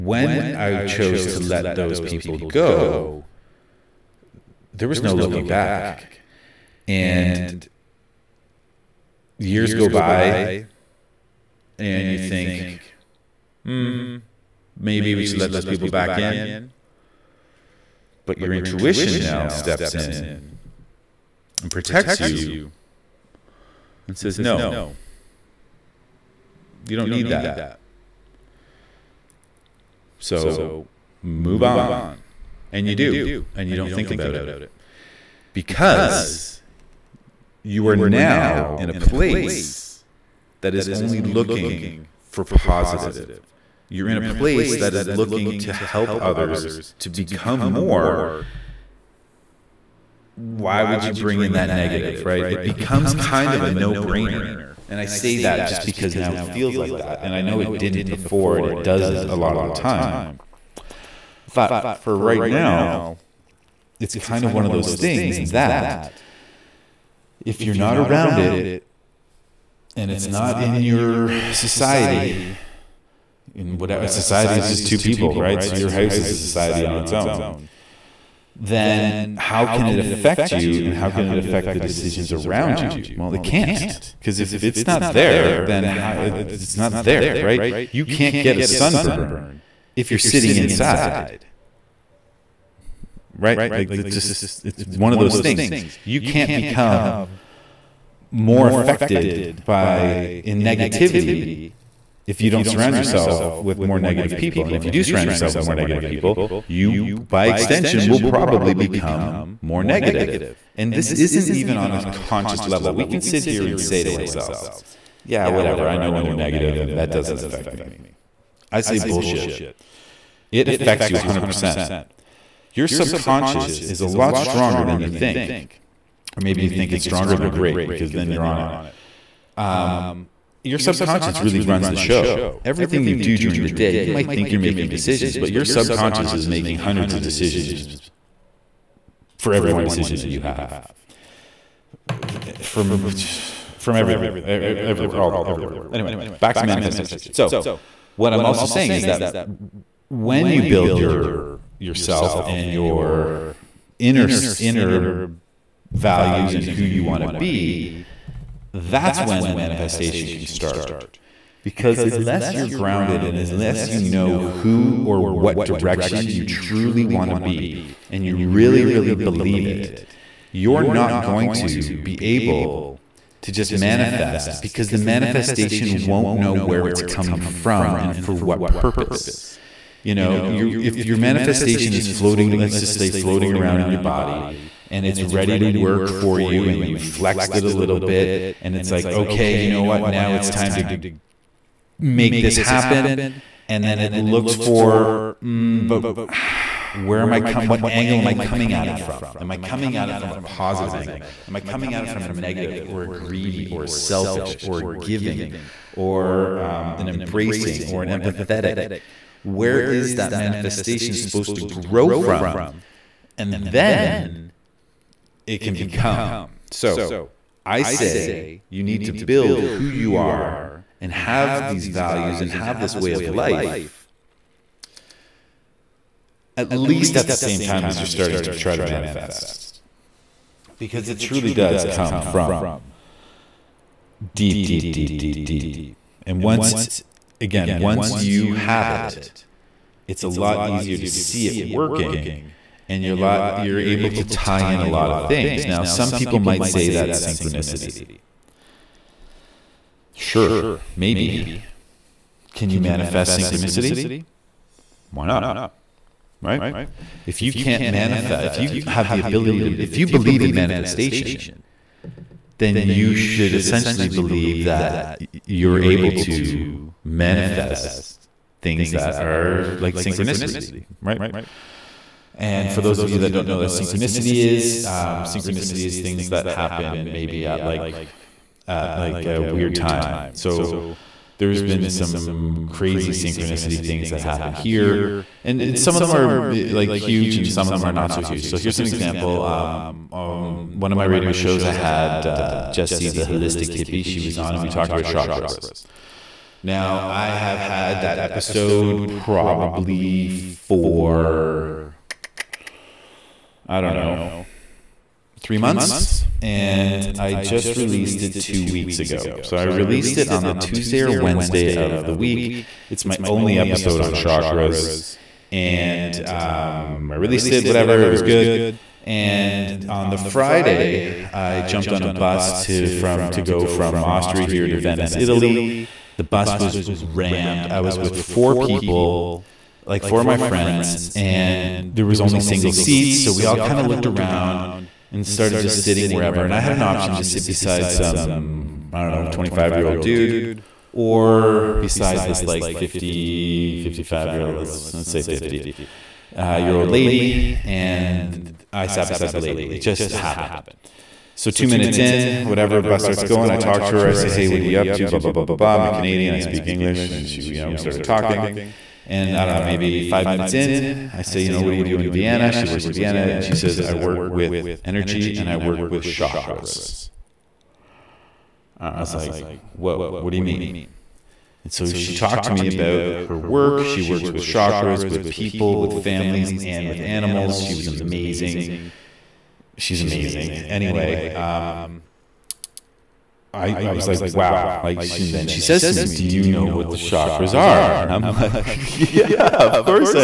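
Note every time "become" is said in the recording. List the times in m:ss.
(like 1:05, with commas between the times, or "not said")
0:47, 0:52, 1:36, 1:48, 3:35.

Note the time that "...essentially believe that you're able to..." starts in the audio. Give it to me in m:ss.
4:23.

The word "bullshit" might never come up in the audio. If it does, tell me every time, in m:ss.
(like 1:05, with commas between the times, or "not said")
1:58.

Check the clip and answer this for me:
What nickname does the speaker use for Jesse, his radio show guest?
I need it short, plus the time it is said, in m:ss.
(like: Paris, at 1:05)
the holistic hippie, at 4:53.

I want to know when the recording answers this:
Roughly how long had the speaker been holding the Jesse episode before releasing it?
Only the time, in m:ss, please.
5:05.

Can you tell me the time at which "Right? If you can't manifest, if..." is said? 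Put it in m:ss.
4:16.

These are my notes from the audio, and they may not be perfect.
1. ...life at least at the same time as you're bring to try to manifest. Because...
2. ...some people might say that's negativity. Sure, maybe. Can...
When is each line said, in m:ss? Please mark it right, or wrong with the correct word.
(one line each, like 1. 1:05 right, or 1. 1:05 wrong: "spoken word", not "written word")
1. 3:43 wrong: "starting", not "bring"
2. 4:05 wrong: "synchronicity", not "negativity".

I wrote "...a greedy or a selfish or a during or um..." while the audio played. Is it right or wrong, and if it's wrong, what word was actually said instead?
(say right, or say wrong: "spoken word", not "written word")
wrong: "giving", not "during".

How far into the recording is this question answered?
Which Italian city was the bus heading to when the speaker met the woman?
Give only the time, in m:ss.
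5:24.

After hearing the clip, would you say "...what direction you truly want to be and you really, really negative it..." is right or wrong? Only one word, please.
wrong.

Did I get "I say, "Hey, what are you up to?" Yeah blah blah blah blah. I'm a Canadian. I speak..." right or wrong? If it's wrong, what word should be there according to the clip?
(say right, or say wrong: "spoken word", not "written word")
wrong: "Blah", not "Yeah".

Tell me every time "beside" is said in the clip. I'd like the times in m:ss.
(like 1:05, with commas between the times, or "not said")
5:37, 5:41, 5:49.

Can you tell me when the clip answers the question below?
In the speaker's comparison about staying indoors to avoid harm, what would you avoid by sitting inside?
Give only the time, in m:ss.
1:28.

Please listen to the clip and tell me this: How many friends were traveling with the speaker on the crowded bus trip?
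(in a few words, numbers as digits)
4.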